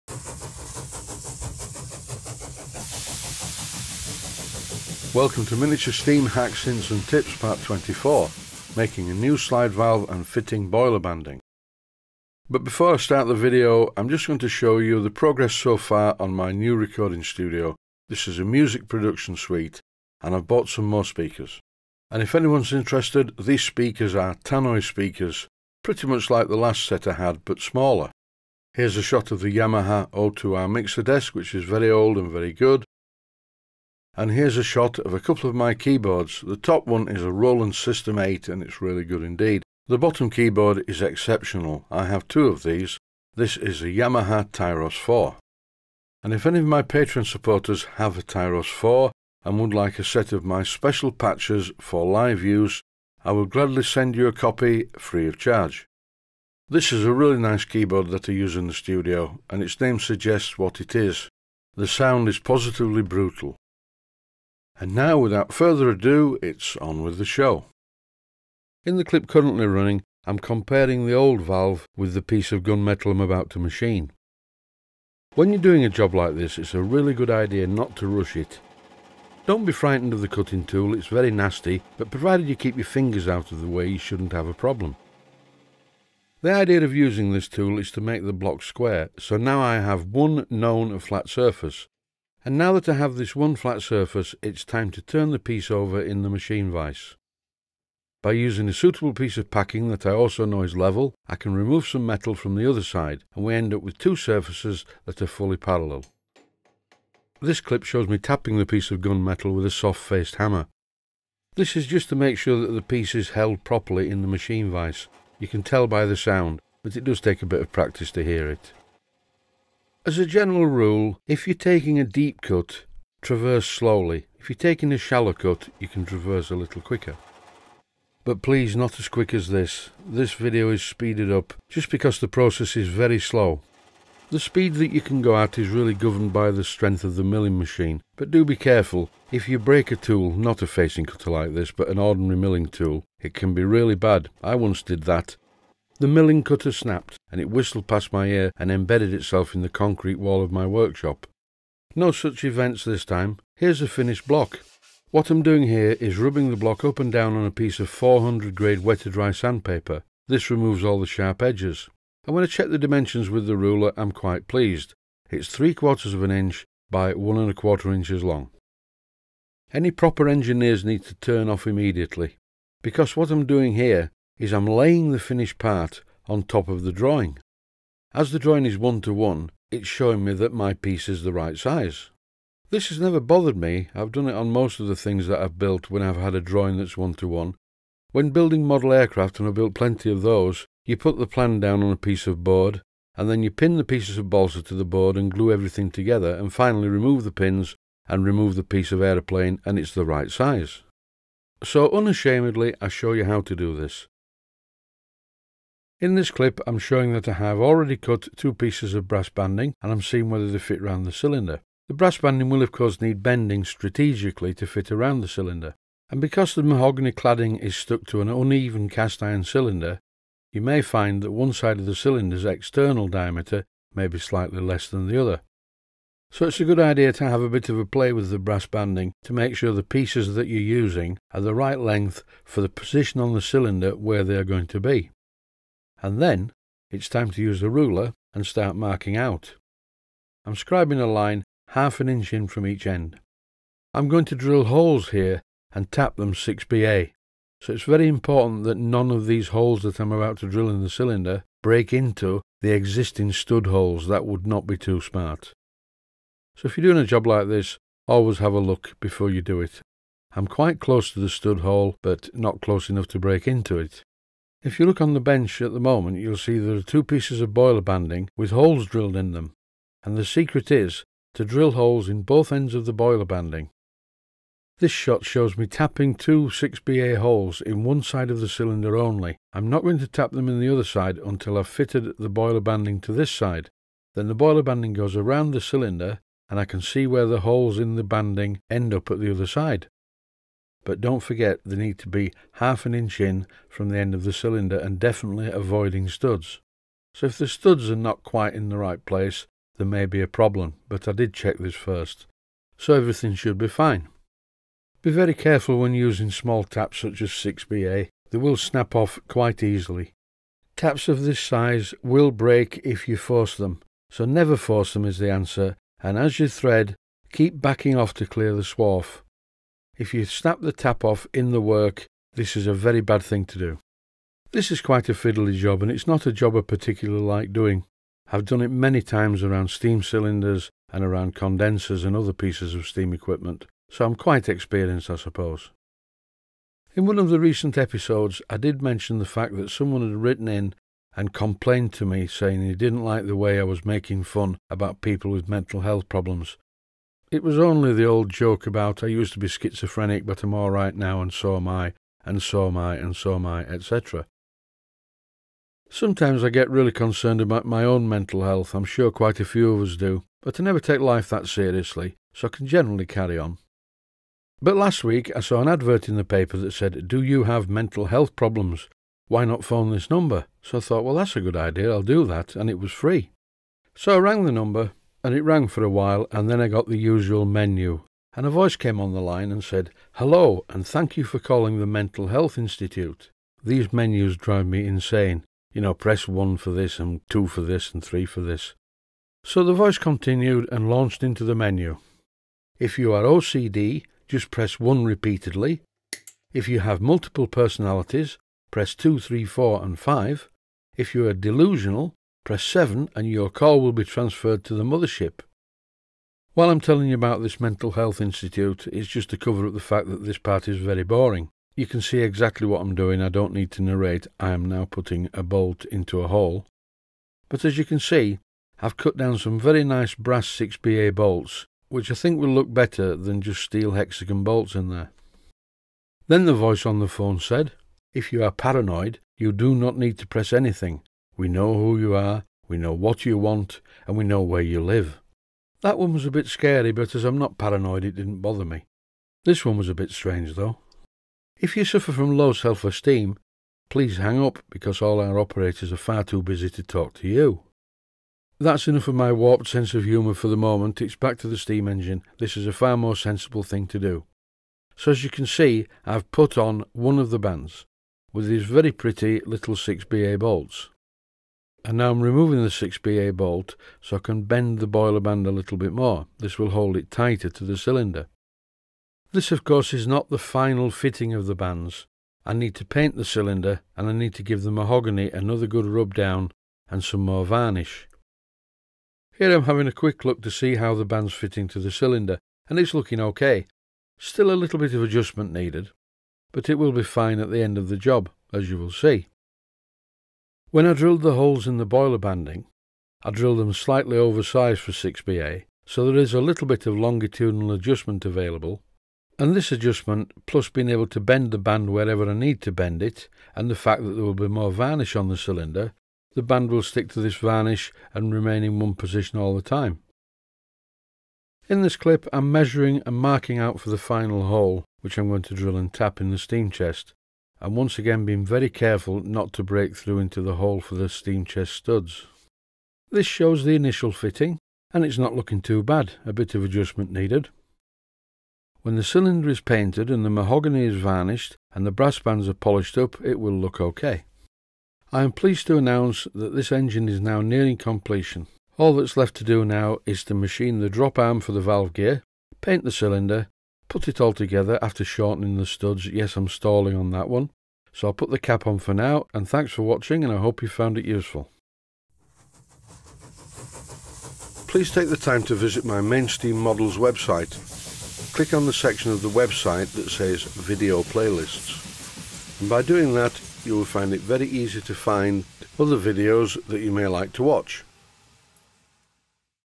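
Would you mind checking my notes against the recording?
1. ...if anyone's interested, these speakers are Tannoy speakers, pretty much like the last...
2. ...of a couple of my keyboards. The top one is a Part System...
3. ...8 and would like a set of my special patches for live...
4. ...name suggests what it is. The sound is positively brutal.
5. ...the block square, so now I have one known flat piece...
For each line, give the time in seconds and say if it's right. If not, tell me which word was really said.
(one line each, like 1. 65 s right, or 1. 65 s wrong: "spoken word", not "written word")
1. 22 s right
2. 34 s wrong: "Roland", not "Part"
3. 48 s wrong: "4", not "8"
4. 59 s right
5. 88 s wrong: "surface", not "piece".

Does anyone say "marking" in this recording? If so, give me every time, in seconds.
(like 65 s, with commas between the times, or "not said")
238 s, 513 s.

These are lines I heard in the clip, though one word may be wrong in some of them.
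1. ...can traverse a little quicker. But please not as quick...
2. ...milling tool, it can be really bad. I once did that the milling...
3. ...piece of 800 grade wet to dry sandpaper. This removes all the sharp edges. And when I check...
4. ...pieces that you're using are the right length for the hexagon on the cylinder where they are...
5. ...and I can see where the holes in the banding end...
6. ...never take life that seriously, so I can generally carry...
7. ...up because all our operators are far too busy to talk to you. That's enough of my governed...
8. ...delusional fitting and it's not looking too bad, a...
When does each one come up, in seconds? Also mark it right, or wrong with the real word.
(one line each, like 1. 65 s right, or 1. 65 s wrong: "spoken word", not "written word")
1. 125 s right
2. 142 s right
3. 157 s wrong: "400", not "800"
4. 229 s wrong: "position", not "hexagon"
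5. 286 s right
6. 360 s right
7. 444 s wrong: "warped", not "governed"
8. 523 s wrong: "initial", not "delusional".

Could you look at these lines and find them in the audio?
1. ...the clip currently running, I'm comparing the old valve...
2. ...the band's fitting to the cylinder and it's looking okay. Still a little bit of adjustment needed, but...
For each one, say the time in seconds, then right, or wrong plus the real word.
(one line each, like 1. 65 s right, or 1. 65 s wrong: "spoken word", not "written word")
1. 68 s right
2. 480 s right.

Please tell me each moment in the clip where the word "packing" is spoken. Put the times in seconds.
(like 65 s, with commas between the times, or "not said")
99 s.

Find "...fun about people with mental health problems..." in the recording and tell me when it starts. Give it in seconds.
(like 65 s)
344 s.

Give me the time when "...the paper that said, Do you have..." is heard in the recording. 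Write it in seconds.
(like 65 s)
366 s.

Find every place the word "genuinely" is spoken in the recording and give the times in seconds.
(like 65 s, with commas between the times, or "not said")
not said.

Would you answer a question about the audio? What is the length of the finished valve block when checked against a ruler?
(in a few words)
1 and a quarter inches.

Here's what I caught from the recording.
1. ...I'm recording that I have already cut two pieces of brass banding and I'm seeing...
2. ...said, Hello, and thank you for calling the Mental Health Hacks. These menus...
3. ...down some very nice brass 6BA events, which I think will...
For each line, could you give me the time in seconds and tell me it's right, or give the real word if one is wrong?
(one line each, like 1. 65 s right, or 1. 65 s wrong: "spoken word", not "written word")
1. 206 s wrong: "showing", not "recording"
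2. 379 s wrong: "Institute", not "Hacks"
3. 419 s wrong: "bolts", not "events".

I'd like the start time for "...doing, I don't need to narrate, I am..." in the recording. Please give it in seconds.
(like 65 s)
412 s.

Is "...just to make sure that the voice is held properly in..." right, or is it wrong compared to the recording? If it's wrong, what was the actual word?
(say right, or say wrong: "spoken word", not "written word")
wrong: "piece", not "voice".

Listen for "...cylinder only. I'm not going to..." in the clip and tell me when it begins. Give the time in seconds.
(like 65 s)
278 s.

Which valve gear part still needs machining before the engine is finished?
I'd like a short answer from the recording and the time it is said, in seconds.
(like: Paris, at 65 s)
the drop arm, at 540 s.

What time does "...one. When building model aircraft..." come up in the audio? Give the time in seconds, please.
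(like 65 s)
187 s.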